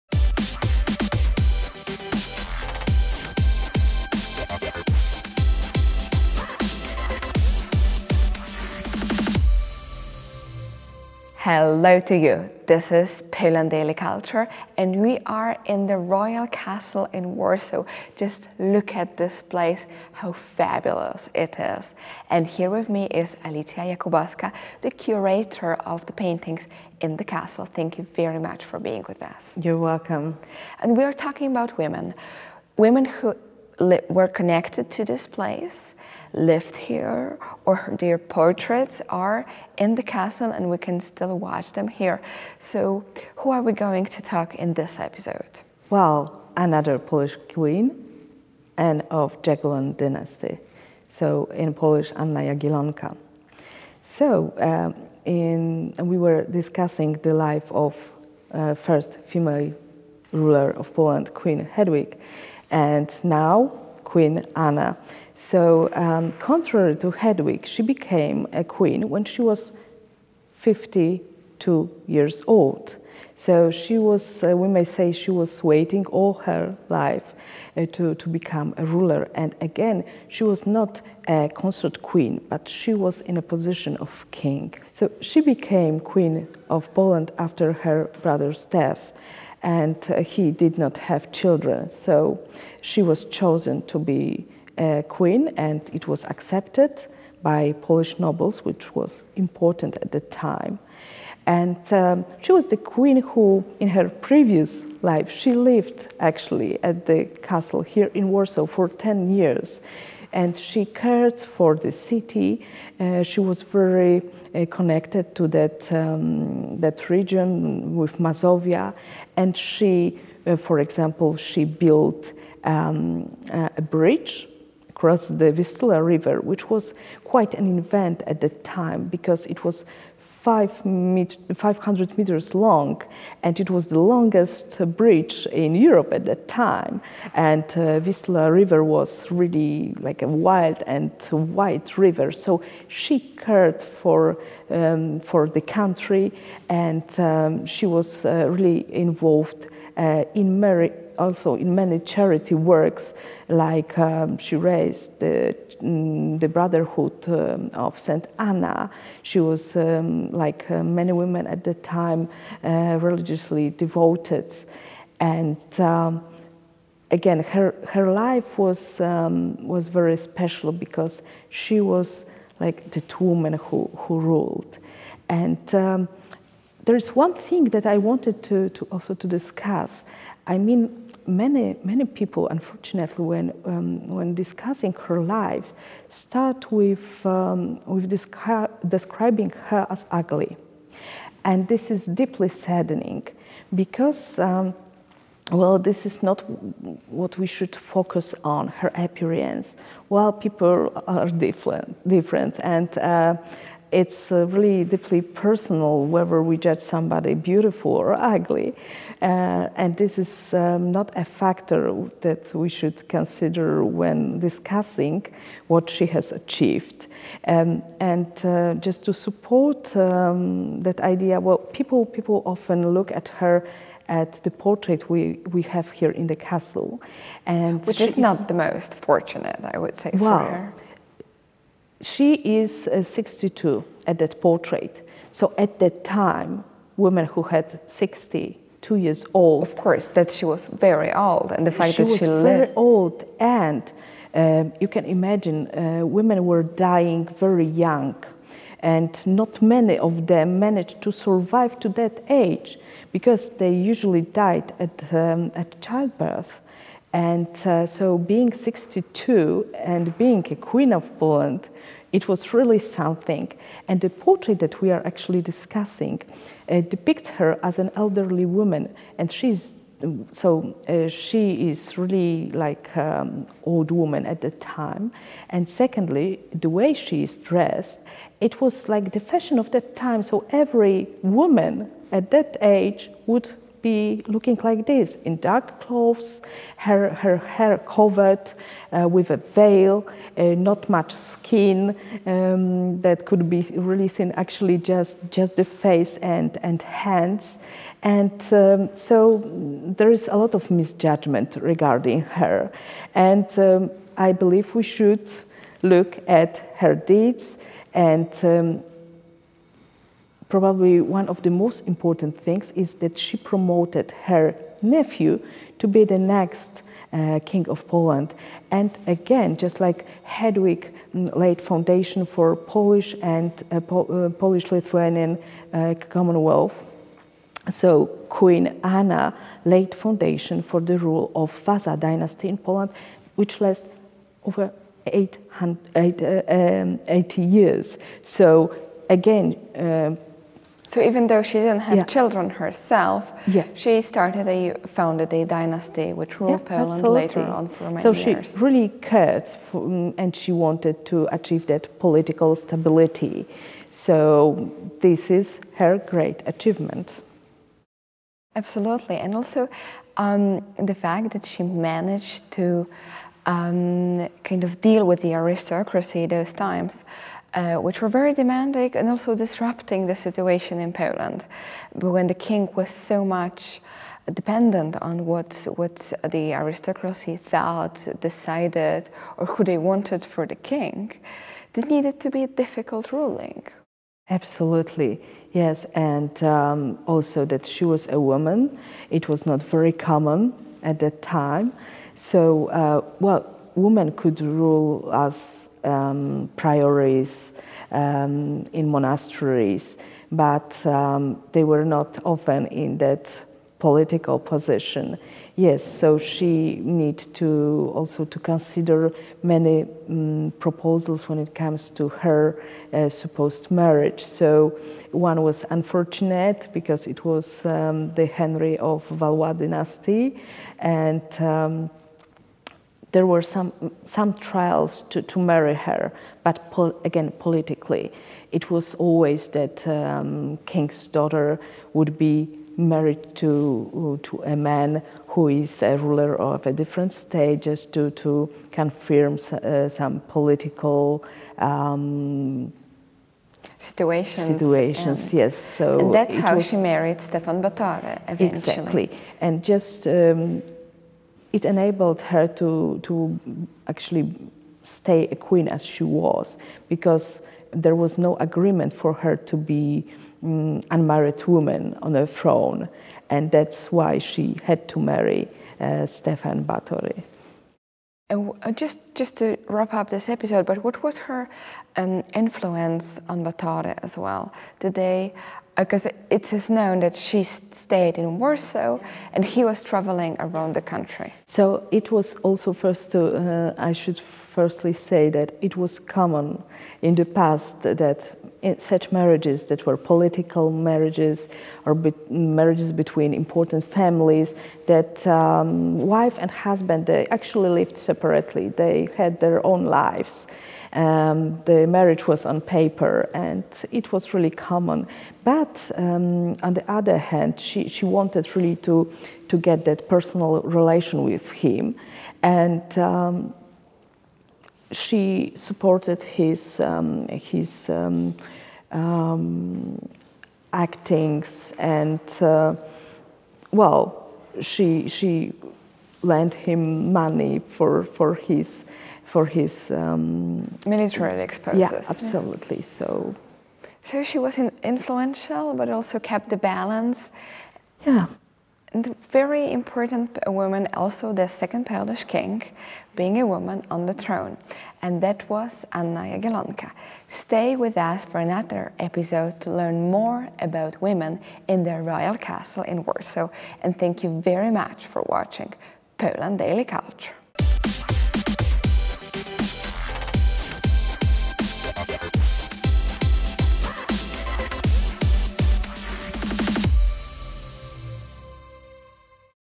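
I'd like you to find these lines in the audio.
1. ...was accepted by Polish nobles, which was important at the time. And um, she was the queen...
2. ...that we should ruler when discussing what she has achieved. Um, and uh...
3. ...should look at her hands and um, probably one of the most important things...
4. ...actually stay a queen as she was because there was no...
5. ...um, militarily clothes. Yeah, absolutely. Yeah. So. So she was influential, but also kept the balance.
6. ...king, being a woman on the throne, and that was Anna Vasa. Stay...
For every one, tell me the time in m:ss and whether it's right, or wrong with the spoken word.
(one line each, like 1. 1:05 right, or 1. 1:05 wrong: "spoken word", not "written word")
1. 1:36 right
2. 3:32 wrong: "consider", not "ruler"
3. 5:04 wrong: "deeds", not "hands"
4. 7:33 right
5. 8:49 wrong: "exposes", not "clothes"
6. 9:02 wrong: "Jagiellonka", not "Vasa".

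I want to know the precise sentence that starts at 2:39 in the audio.
She was, um, like uh, many women at the time, uh, religiously devoted.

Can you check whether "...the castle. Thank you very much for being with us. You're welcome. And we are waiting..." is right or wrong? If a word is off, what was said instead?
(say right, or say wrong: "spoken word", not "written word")
wrong: "talking", not "waiting".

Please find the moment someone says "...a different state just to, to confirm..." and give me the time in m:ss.
7:16.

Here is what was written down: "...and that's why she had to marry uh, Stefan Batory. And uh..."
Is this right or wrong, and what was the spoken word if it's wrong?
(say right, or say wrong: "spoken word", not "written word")
right.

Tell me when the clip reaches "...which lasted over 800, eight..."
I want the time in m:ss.
5:33.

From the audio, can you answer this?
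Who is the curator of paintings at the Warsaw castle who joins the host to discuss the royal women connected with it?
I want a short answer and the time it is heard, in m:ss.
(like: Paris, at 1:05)
Alicja Jakubowska, at 0:23.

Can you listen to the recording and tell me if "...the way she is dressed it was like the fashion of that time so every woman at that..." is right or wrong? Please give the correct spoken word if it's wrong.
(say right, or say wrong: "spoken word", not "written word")
right.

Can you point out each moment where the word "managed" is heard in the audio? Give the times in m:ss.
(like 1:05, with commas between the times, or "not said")
4:10, 6:01.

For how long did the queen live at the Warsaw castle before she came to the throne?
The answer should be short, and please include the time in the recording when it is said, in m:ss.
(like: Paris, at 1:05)
10 years, at 1:48.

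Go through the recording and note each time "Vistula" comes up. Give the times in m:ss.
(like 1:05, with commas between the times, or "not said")
2:05, 2:17.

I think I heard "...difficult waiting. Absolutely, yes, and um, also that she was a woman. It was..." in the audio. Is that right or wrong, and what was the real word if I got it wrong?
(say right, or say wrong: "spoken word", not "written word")
wrong: "ruling", not "waiting".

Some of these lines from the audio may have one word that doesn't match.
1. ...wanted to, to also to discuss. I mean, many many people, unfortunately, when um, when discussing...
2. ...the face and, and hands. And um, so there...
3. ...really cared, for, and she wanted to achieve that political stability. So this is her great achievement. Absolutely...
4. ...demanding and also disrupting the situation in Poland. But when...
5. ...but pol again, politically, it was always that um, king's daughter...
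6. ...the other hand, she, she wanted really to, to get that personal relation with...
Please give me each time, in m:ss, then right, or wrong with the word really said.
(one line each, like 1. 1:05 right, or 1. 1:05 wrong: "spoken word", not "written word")
1. 2:57 right
2. 4:55 right
3. 5:48 right
4. 6:08 right
5. 7:06 right
6. 8:26 right.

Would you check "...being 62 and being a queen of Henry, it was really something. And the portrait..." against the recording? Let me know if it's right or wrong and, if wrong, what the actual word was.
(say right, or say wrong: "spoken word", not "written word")
wrong: "Poland", not "Henry".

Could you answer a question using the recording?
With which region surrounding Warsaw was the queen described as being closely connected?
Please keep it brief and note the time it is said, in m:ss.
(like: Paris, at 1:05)
Mazovia, at 1:58.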